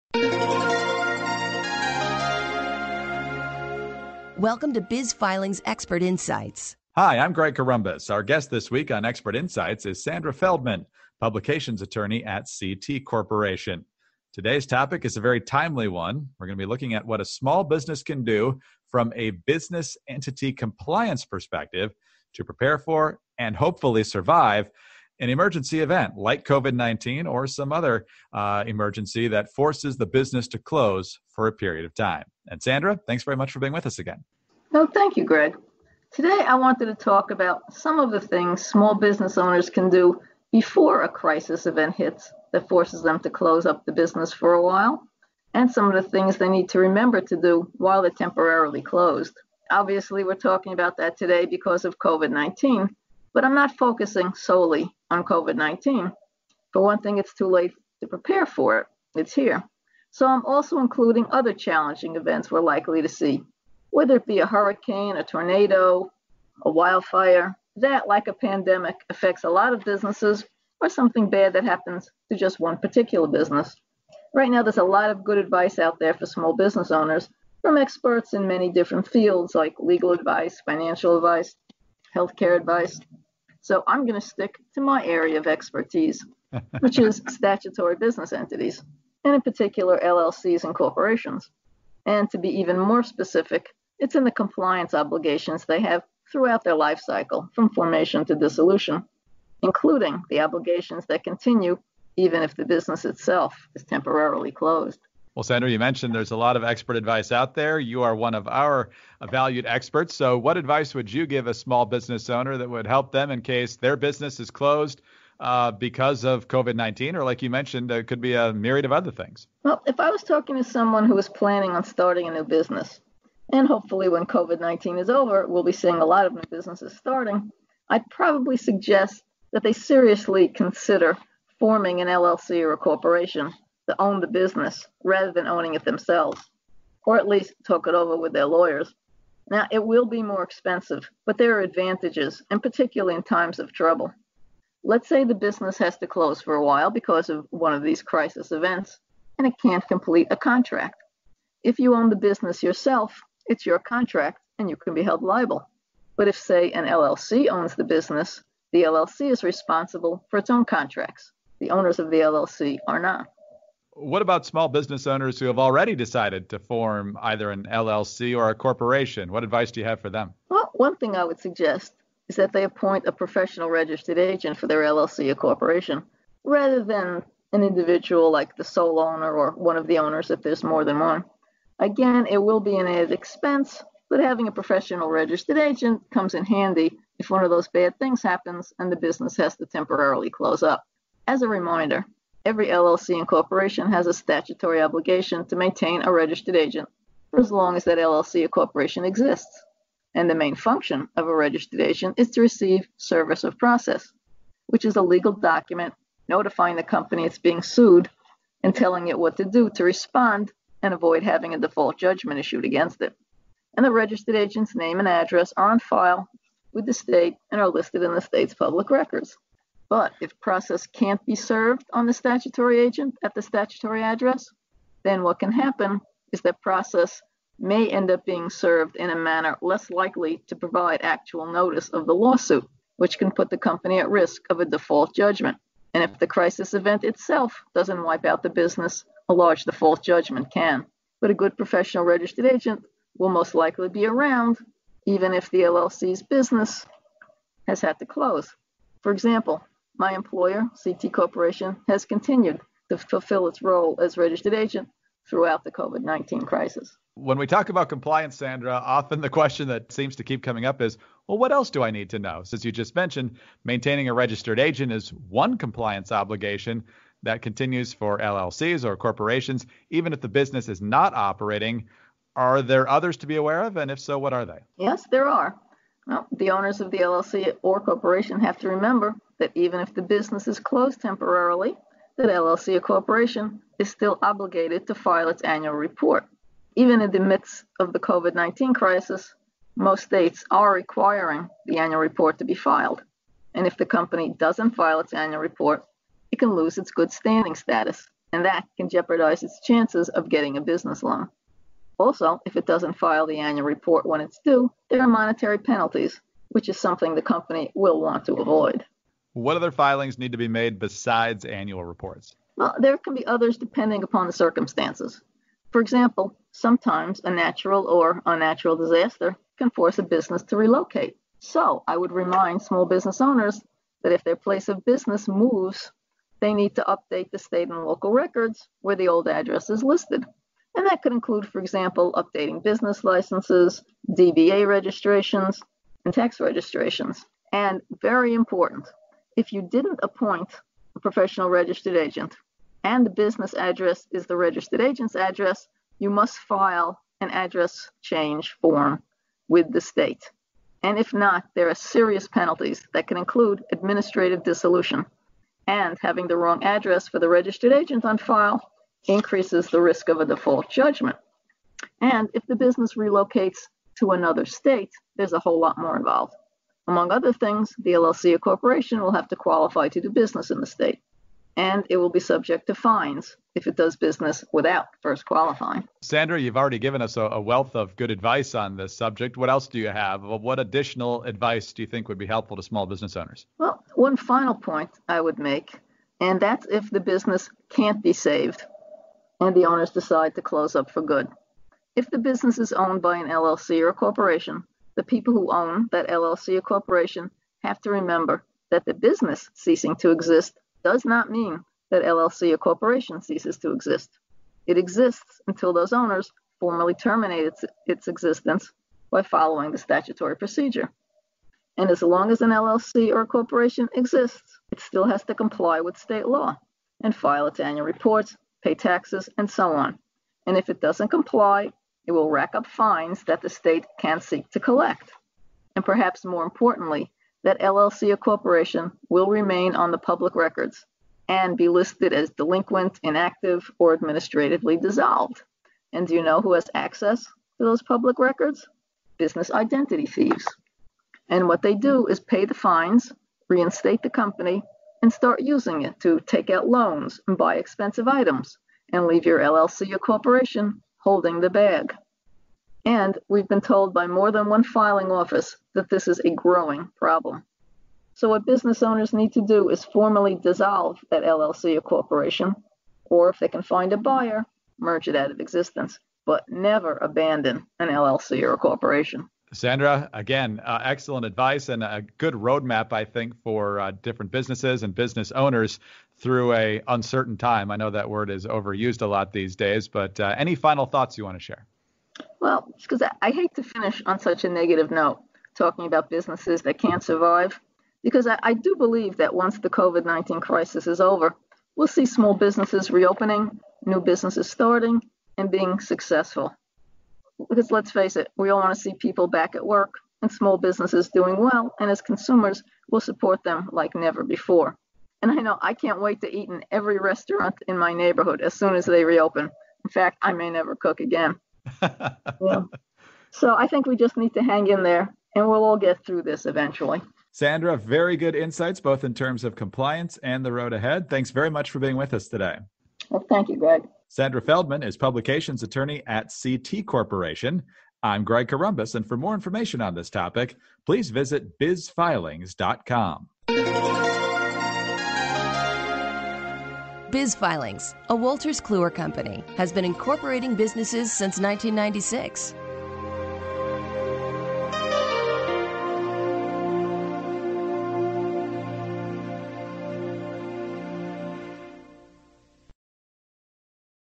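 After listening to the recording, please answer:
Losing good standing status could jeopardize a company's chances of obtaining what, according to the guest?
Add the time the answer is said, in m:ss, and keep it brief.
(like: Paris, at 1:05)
a business loan, at 5:00.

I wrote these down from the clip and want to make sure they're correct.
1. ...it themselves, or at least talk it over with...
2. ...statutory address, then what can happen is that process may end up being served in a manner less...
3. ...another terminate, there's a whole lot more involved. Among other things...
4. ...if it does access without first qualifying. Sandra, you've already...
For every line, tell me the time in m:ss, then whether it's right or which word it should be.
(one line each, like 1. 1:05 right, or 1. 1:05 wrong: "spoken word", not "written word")
1. 2:15 right
2. 3:43 right
3. 6:04 wrong: "state", not "terminate"
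4. 6:13 wrong: "business", not "access".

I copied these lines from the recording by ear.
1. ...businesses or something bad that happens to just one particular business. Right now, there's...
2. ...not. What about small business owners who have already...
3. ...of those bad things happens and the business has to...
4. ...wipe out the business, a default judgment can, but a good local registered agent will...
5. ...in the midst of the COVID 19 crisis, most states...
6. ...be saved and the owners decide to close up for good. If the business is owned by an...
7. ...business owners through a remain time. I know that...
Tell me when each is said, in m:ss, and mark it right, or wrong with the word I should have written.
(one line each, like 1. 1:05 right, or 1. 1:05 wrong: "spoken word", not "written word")
1. 1:09 right
2. 2:42 right
3. 3:07 right
4. 3:58 wrong: "professional", not "local"
5. 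4:47 right
6. 6:28 right
7. 7:54 wrong: "uncertain", not "remain".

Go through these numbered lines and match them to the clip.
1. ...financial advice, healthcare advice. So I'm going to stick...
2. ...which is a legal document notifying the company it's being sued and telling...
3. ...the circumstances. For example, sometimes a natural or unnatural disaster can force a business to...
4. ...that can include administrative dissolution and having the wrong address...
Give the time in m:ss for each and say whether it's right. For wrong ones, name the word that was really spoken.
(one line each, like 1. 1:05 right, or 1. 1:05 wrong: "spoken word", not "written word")
1. 1:20 right
2. 3:24 right
3. 5:14 right
4. 5:52 right.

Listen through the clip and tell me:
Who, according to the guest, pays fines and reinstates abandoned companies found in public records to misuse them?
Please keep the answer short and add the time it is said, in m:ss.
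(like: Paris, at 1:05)
Business identity thieves, at 7:19.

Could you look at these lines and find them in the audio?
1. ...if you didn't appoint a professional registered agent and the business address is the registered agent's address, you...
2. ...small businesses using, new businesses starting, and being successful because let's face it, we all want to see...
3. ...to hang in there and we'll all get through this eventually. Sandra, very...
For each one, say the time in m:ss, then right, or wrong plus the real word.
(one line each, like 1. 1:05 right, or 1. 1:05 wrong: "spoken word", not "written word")
1. 5:39 right
2. 8:12 wrong: "reopening", not "using"
3. 8:34 right.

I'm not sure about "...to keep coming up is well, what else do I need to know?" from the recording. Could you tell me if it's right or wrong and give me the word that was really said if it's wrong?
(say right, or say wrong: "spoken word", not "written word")
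right.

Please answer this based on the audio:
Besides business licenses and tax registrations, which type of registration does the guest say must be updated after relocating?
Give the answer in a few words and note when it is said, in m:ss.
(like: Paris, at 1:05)
DBA registrations, at 5:34.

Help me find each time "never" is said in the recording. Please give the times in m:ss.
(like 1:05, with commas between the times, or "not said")
7:46, 8:23, 8:30.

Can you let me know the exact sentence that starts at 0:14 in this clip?
Today's topic is a very timely one.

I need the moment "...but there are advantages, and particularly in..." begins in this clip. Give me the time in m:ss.
2:21.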